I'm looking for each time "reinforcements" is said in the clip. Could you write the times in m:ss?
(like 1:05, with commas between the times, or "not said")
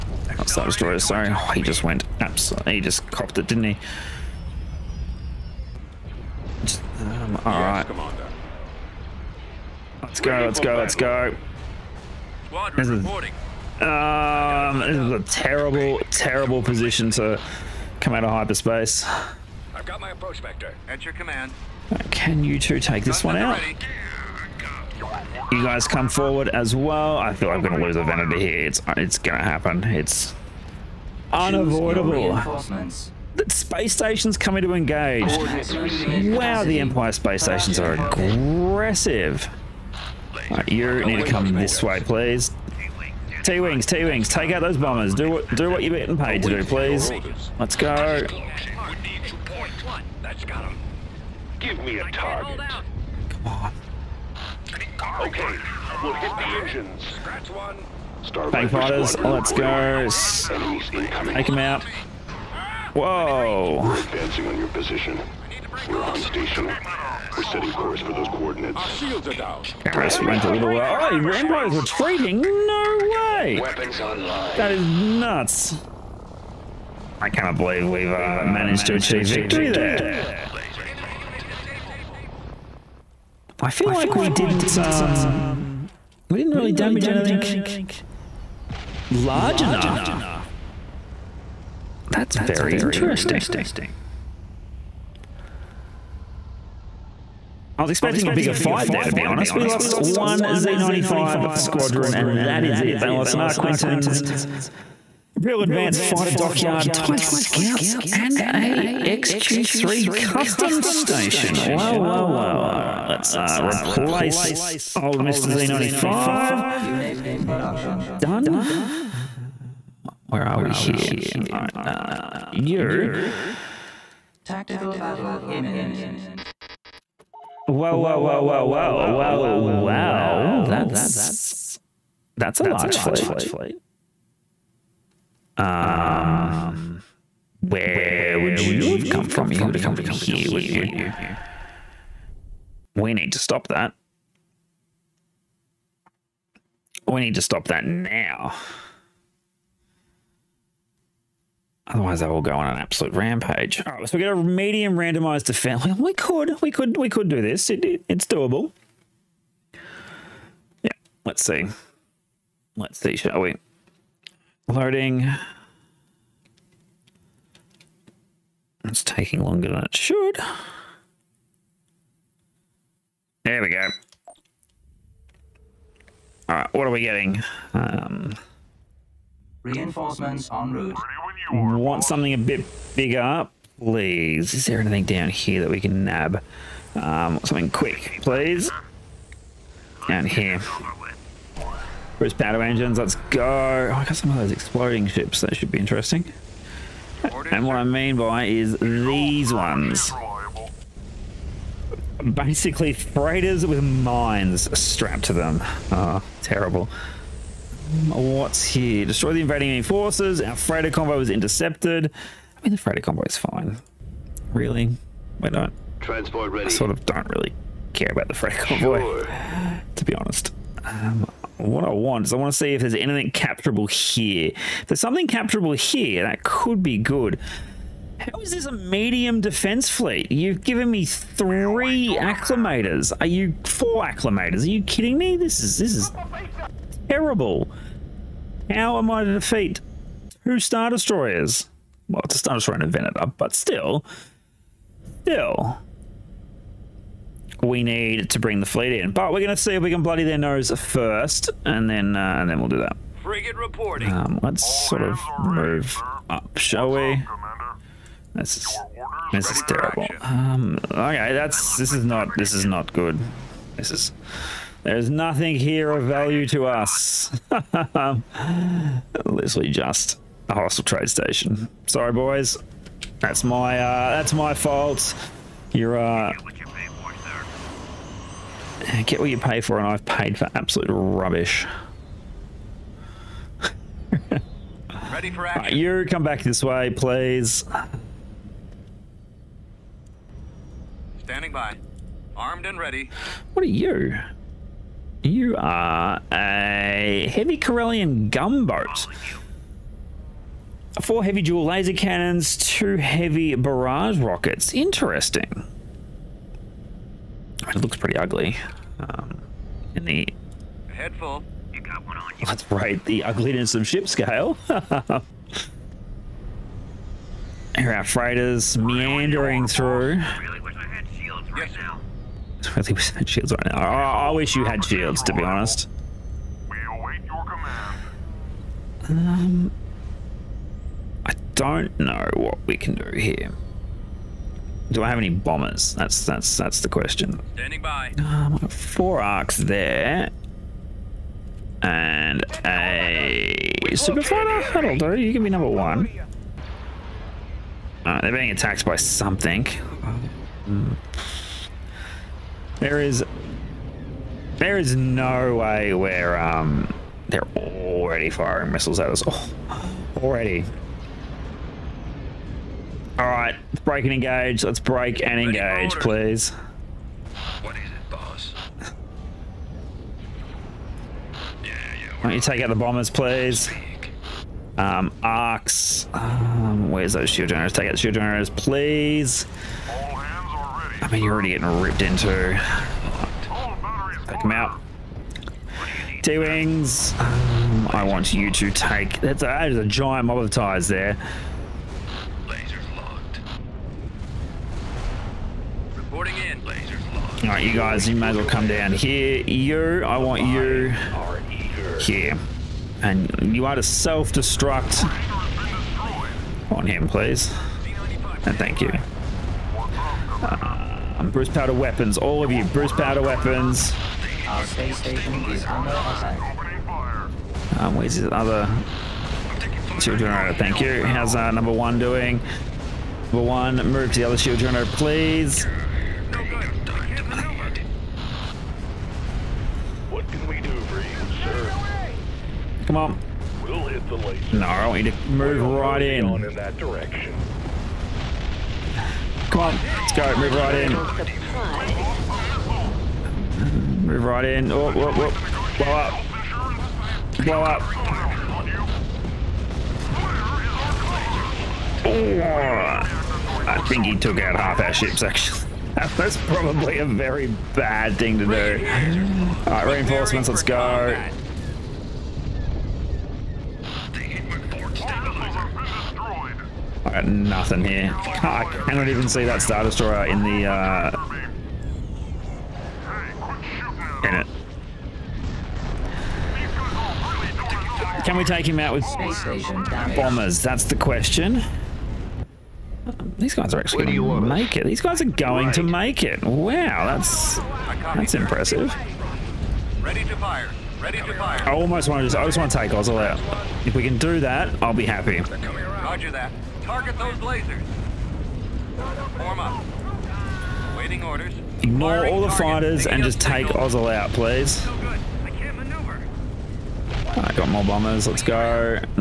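2:59, 7:39.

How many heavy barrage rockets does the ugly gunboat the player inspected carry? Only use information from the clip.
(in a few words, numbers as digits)
2.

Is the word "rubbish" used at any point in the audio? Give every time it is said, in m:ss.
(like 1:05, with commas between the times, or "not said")
4:40.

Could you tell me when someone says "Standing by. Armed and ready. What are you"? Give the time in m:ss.
4:51.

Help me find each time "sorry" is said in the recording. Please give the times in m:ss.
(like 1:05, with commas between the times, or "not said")
0:01, 4:31.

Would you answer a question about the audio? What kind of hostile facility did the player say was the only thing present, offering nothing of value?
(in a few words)
trade station.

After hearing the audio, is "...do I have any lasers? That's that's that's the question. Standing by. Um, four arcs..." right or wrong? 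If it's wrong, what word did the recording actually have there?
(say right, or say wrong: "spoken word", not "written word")
wrong: "bombers", not "lasers".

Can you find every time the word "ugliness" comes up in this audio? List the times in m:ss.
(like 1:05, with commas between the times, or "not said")
5:13.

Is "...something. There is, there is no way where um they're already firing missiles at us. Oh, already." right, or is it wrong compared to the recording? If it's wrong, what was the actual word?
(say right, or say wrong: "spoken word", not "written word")
right.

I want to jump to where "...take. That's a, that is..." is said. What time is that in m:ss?
6:28.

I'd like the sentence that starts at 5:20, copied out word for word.
I really wish I had shields right now.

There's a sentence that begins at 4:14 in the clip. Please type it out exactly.
Um, let's All sort of move up, shall What's we?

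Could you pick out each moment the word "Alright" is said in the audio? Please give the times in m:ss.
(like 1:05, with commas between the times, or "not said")
2:56.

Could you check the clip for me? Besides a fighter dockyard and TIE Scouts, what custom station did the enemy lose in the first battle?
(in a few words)
XQ3 Custom Station.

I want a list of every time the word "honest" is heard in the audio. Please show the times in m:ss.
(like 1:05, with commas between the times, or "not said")
1:39, 3:40, 5:25.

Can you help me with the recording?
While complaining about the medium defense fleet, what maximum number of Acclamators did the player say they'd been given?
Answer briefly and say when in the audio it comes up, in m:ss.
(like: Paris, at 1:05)
4, at 3:53.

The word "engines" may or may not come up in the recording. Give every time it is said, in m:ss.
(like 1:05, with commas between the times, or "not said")
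0:56, 3:12.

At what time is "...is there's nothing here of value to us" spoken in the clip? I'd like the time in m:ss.
4:23.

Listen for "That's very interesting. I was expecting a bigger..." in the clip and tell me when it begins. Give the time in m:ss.
1:32.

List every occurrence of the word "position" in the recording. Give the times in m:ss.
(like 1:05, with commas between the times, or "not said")
0:16, 1:04.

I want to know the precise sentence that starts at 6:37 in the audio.
All right, you guys, you may as well come down here.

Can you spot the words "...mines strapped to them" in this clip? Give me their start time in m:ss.
3:23.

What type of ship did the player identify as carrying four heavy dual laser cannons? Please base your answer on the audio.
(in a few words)
heavy Corellian gunboat.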